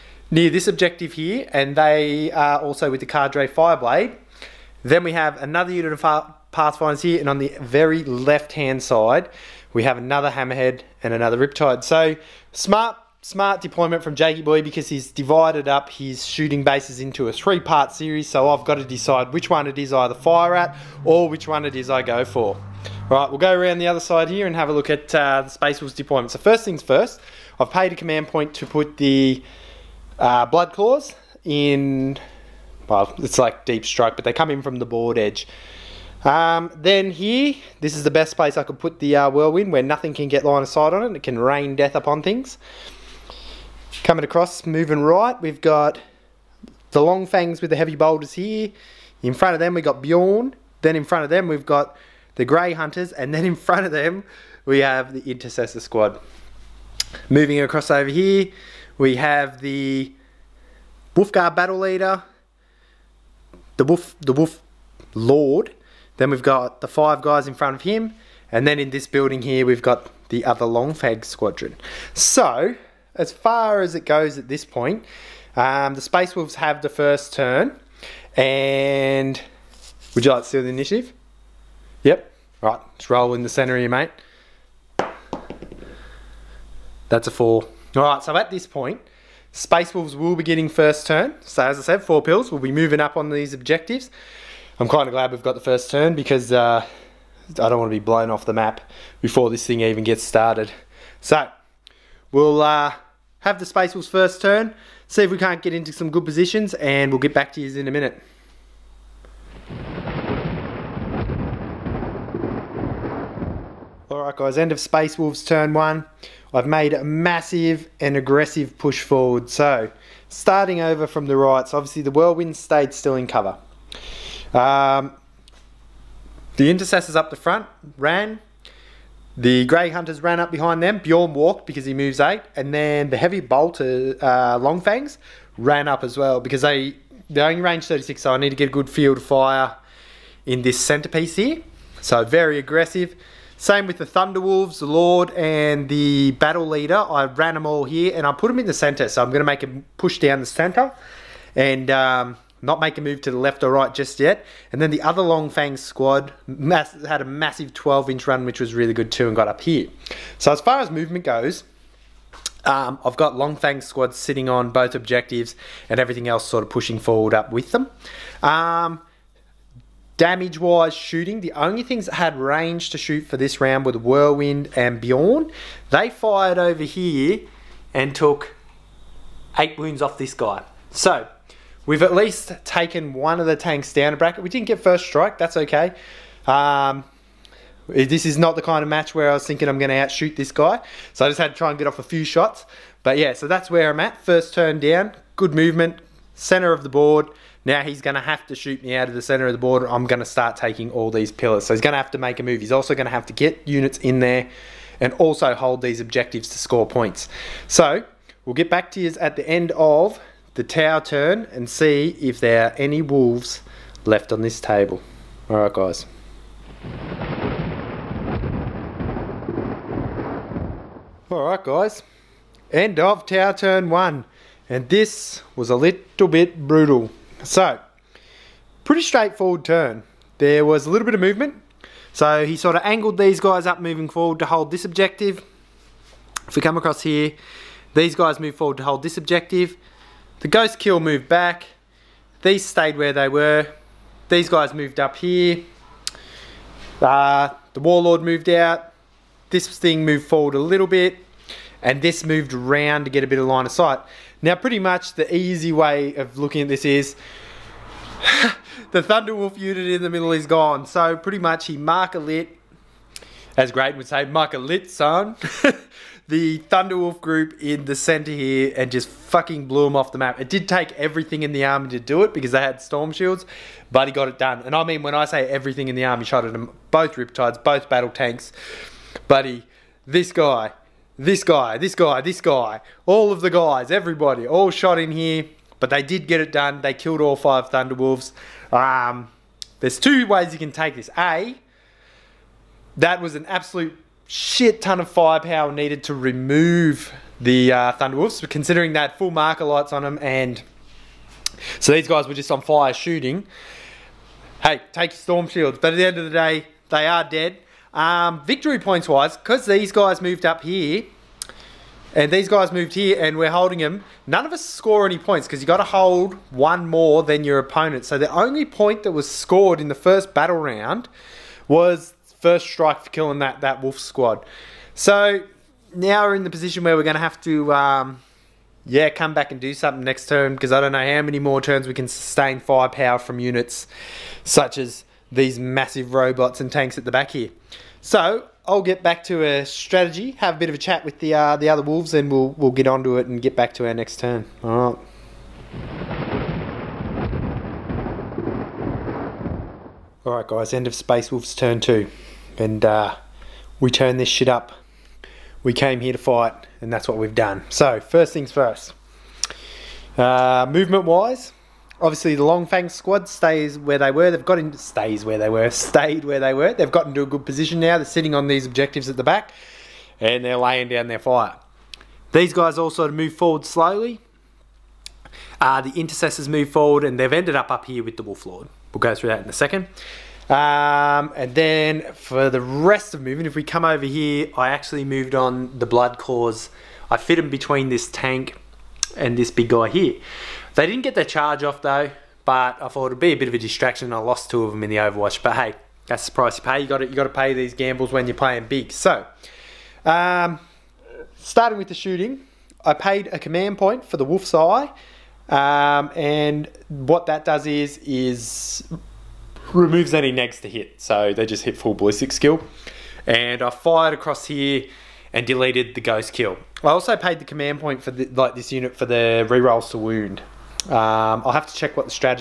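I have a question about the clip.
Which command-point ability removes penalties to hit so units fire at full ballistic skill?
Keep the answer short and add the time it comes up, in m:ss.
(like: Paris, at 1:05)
Wolf's Eye, at 6:44.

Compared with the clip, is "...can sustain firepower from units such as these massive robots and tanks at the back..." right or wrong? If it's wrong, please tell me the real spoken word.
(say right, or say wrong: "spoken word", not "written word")
right.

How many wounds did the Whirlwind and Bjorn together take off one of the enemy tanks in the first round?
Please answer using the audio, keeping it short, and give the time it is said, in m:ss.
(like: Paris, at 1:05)
8, at 2:59.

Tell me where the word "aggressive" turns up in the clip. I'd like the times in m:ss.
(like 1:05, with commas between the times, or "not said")
1:58, 2:22.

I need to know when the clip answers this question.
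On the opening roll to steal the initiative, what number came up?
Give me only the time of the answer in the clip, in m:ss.
1:27.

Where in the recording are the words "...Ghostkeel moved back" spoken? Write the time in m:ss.
4:00.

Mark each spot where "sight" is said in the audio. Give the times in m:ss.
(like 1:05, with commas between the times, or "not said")
0:40, 4:13.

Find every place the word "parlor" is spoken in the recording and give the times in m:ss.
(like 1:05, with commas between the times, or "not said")
not said.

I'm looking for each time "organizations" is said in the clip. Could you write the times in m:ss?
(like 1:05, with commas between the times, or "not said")
not said.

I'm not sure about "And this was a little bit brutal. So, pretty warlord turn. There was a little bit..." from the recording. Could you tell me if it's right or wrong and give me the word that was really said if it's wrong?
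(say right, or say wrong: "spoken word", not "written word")
wrong: "straightforward", not "warlord".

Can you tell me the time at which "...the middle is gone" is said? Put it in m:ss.
4:20.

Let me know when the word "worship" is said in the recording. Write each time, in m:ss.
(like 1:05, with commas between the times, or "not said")
not said.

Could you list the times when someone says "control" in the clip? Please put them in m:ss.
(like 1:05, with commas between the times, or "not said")
not said.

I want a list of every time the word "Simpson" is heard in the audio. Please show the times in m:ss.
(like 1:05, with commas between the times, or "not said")
not said.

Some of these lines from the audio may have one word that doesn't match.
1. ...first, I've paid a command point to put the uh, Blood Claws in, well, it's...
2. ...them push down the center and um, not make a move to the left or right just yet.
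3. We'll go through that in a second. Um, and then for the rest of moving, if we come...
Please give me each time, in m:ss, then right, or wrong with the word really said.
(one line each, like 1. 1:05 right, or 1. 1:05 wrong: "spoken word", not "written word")
1. 0:26 right
2. 2:29 right
3. 6:18 right.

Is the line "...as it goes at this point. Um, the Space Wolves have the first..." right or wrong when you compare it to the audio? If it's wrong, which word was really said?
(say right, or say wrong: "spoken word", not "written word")
right.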